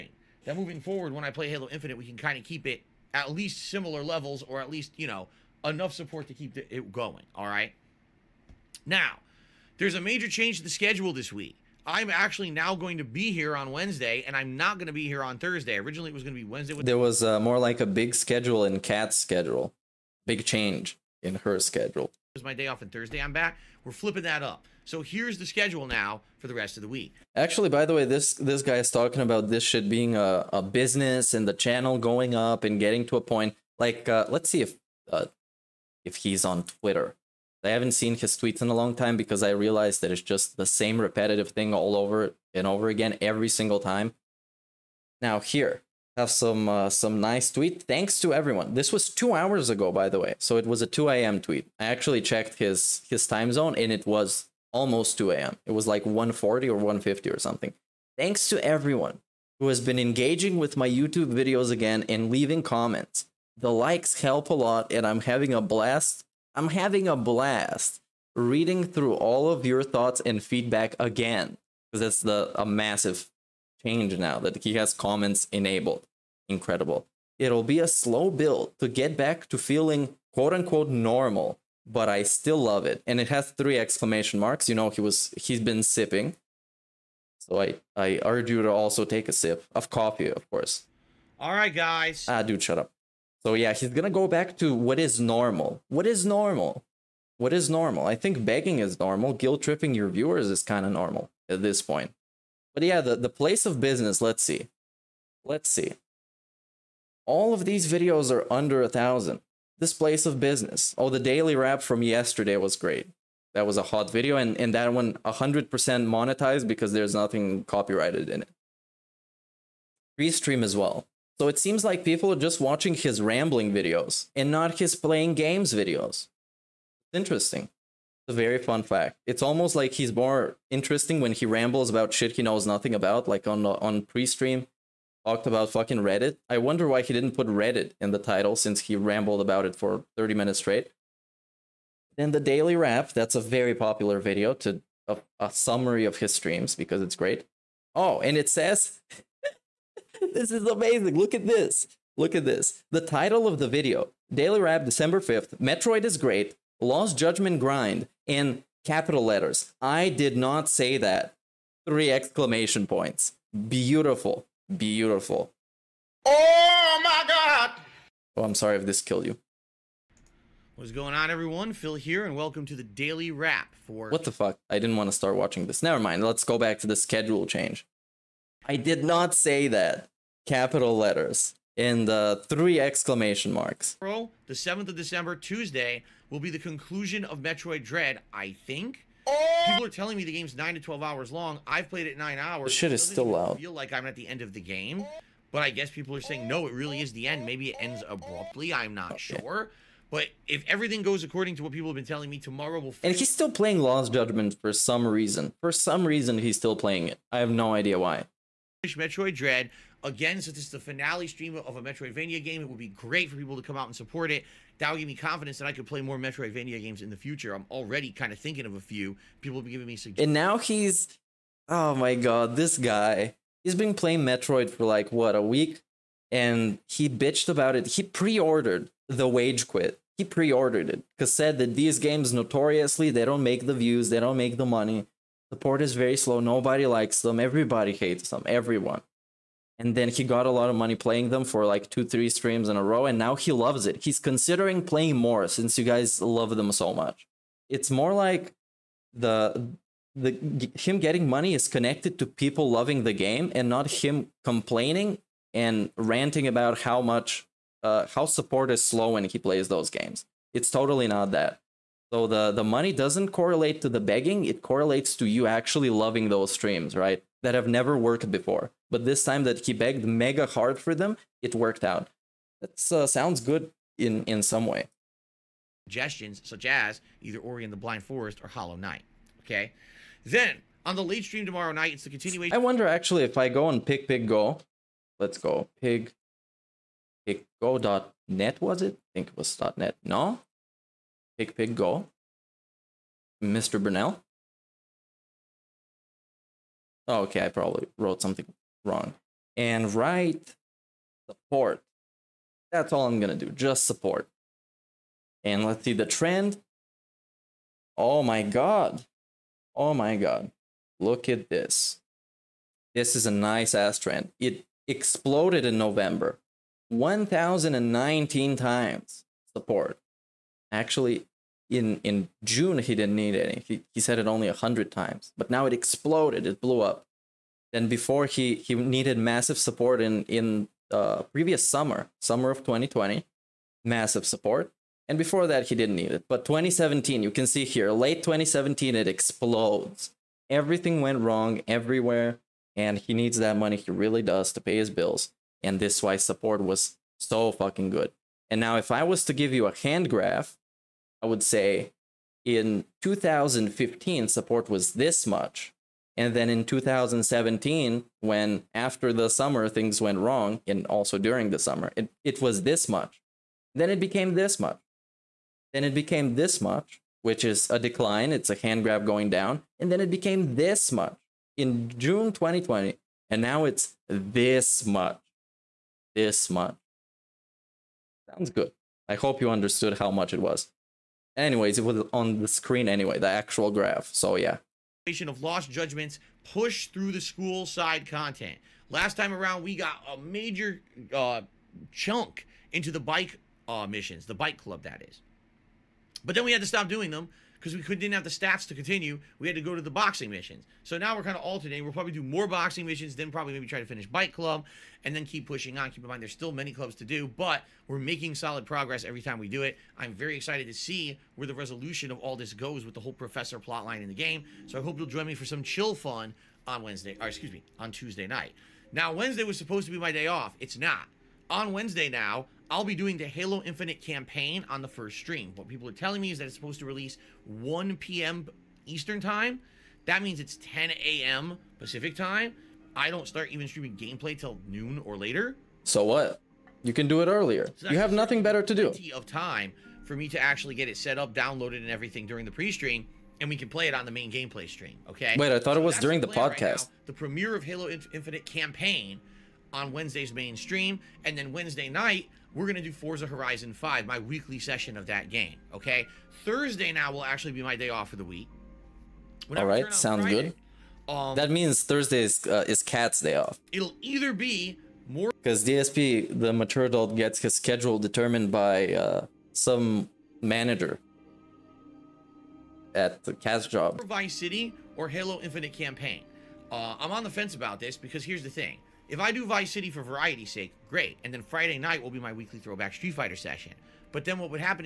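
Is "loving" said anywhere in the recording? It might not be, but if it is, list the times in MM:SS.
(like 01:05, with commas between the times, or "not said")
04:12, 04:25.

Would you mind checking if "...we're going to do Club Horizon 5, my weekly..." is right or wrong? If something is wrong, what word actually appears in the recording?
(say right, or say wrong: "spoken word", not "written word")
wrong: "Forza", not "Club".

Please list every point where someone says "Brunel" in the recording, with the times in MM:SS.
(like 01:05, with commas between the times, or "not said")
04:53.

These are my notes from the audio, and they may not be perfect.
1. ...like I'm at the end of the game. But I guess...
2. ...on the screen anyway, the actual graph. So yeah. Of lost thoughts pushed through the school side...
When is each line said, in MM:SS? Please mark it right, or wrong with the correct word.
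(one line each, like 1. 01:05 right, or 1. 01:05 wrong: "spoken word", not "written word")
1. 03:13 right
2. 06:22 wrong: "judgments", not "thoughts".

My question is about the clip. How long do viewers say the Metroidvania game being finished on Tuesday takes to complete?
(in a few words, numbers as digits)
9 to 12 hours.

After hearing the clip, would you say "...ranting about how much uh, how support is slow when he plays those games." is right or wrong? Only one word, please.
right.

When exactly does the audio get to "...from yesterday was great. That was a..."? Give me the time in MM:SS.
01:51.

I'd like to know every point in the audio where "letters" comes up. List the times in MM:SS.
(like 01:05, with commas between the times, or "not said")
02:39, 03:00.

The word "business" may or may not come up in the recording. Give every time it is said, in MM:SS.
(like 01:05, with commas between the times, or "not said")
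00:30, 01:43, 01:50.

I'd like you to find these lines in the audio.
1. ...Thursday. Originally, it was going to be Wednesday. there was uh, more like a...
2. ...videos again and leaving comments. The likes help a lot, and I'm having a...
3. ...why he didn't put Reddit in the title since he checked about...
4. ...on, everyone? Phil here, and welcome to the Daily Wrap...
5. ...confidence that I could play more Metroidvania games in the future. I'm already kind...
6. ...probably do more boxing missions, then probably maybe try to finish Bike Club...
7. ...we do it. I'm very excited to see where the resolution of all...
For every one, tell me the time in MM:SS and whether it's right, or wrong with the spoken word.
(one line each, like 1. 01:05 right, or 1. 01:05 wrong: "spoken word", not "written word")
1. 00:15 right
2. 01:01 right
3. 02:16 wrong: "rambled", not "checked"
4. 02:51 right
5. 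03:35 right
6. 06:41 right
7. 06:49 right.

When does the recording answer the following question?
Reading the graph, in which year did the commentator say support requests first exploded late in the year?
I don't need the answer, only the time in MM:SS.
05:37.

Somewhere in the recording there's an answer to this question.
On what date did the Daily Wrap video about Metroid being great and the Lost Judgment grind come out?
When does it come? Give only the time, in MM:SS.
02:34.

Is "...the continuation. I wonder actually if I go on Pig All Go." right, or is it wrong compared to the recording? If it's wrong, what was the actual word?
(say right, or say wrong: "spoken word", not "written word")
wrong: "Pig", not "All".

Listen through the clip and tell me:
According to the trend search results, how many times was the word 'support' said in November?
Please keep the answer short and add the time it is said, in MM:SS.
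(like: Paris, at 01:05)
1,019, at 05:16.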